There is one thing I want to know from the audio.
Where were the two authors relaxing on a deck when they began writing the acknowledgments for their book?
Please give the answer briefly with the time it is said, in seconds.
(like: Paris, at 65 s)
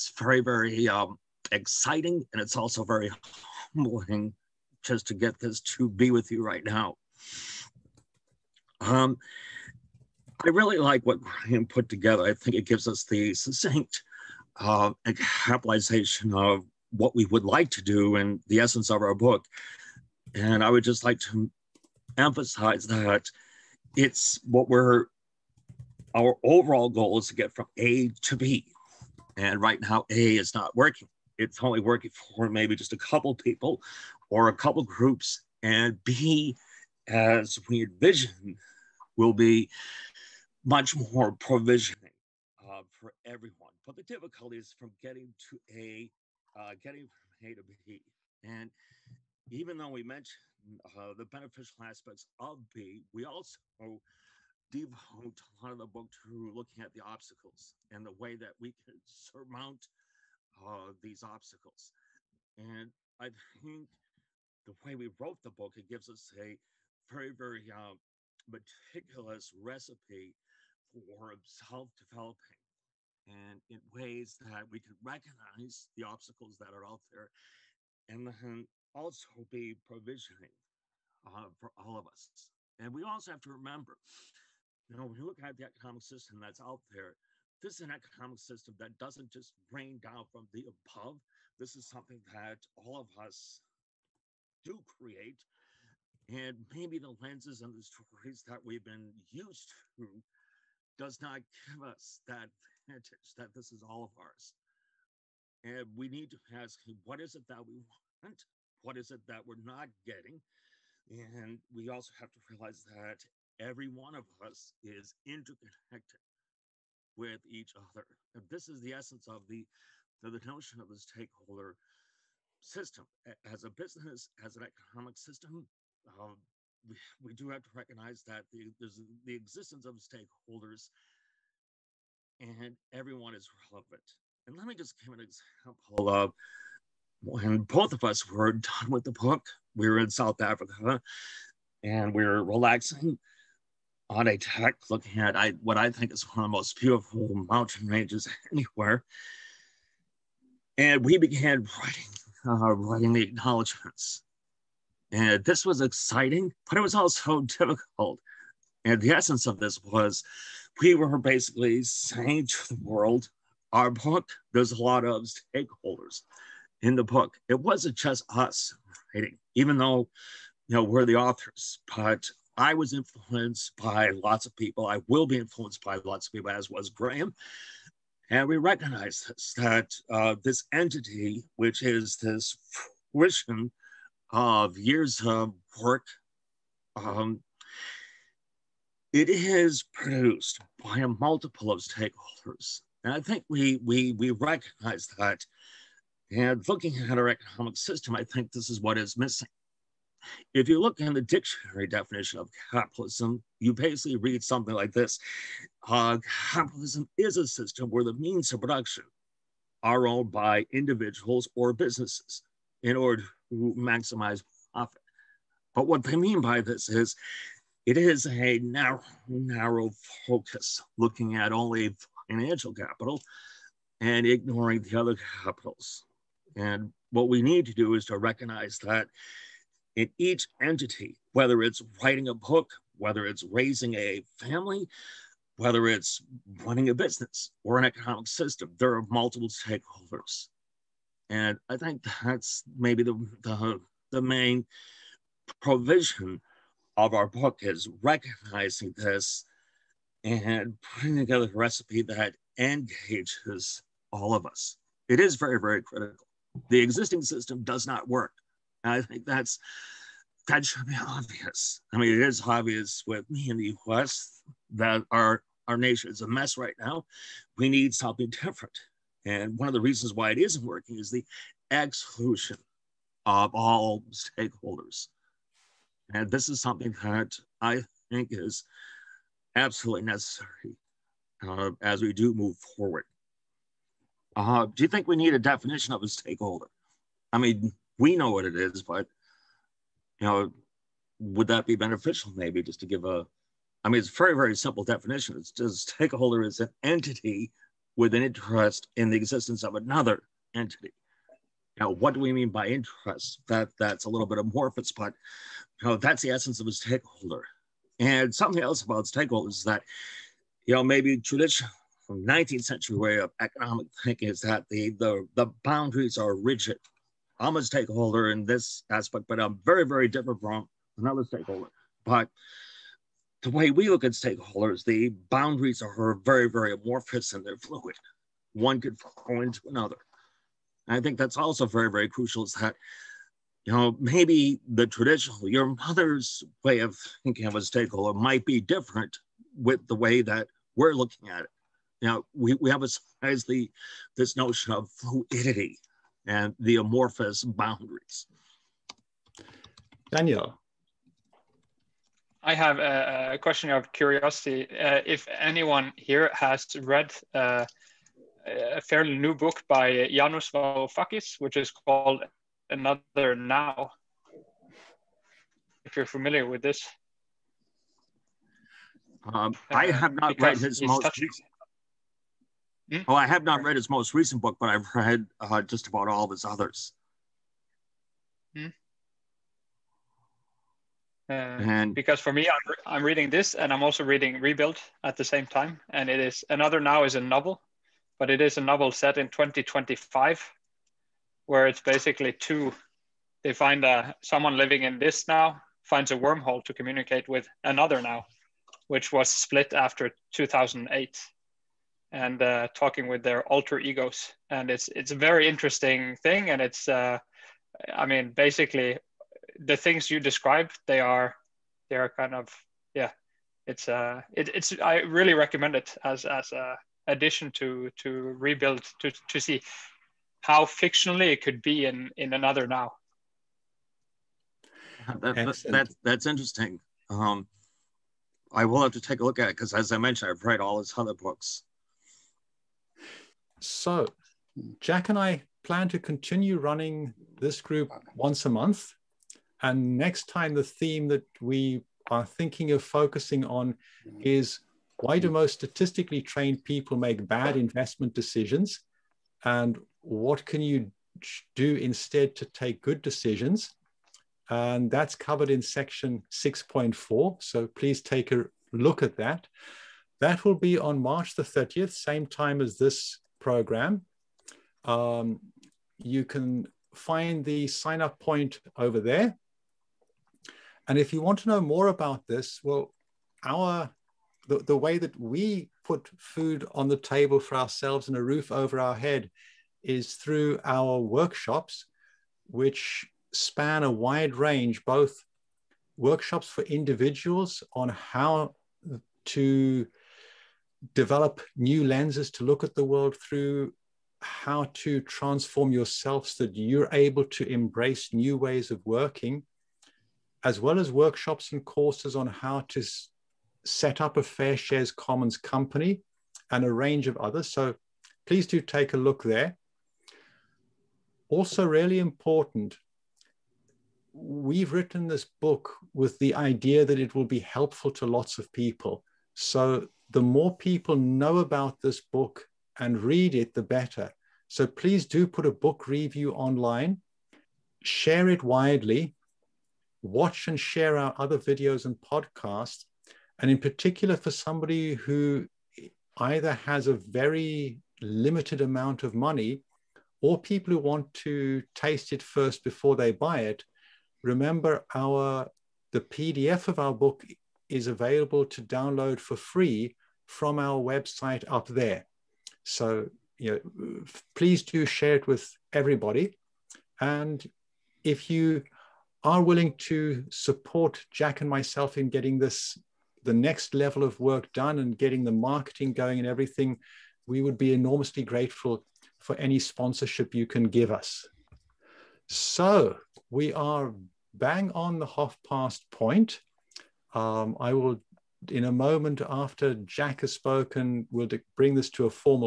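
South Africa, at 140 s.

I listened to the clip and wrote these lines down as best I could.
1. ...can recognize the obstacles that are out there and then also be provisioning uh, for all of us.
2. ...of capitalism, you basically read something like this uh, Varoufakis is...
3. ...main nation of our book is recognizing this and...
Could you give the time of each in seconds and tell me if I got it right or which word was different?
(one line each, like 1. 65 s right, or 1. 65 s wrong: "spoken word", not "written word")
1. 74 s right
2. 202 s wrong: "Capitalism", not "Varoufakis"
3. 244 s wrong: "provision", not "nation".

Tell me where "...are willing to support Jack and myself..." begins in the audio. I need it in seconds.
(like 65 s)
559 s.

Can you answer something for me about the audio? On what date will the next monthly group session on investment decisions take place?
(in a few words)
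March 30.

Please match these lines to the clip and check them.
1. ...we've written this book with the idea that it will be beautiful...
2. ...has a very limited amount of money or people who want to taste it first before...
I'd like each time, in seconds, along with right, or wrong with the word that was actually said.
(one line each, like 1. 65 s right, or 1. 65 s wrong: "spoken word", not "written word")
1. 514 s wrong: "helpful", not "beautiful"
2. 536 s right.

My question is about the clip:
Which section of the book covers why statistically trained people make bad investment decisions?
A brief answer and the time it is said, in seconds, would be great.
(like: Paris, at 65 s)
6.4, at 456 s.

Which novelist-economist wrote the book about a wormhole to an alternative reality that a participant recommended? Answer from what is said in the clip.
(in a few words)
Yanis Varoufakis.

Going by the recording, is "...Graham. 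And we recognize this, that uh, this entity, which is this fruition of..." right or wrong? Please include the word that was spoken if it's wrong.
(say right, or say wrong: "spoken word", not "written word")
right.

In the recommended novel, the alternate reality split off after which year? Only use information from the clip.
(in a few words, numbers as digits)
2008.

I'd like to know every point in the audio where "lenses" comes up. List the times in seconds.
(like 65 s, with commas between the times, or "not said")
97 s, 491 s.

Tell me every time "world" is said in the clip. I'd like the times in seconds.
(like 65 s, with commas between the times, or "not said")
162 s, 492 s.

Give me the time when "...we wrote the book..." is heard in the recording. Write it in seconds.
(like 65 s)
64 s.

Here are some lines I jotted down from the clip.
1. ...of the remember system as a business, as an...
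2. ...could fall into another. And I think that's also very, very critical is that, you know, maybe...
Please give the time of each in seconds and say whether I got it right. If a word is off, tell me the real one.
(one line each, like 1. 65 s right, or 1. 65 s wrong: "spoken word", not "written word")
1. 120 s wrong: "stakeholder", not "remember"
2. 328 s wrong: "crucial", not "critical".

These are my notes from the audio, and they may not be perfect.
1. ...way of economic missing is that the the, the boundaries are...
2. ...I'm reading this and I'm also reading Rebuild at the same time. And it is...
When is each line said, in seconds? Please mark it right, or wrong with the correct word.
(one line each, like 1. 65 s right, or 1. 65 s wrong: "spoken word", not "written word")
1. 312 s wrong: "thinking", not "missing"
2. 382 s right.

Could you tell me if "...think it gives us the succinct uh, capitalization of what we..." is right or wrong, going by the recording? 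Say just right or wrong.
right.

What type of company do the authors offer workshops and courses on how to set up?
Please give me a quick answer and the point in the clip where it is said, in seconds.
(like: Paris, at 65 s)
FairShares Commons company, at 504 s.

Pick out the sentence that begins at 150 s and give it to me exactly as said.
And we began writing, uh, writing the acknowledgments.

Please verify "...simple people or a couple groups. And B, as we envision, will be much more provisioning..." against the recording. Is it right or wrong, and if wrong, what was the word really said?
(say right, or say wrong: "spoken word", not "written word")
wrong: "couple", not "simple".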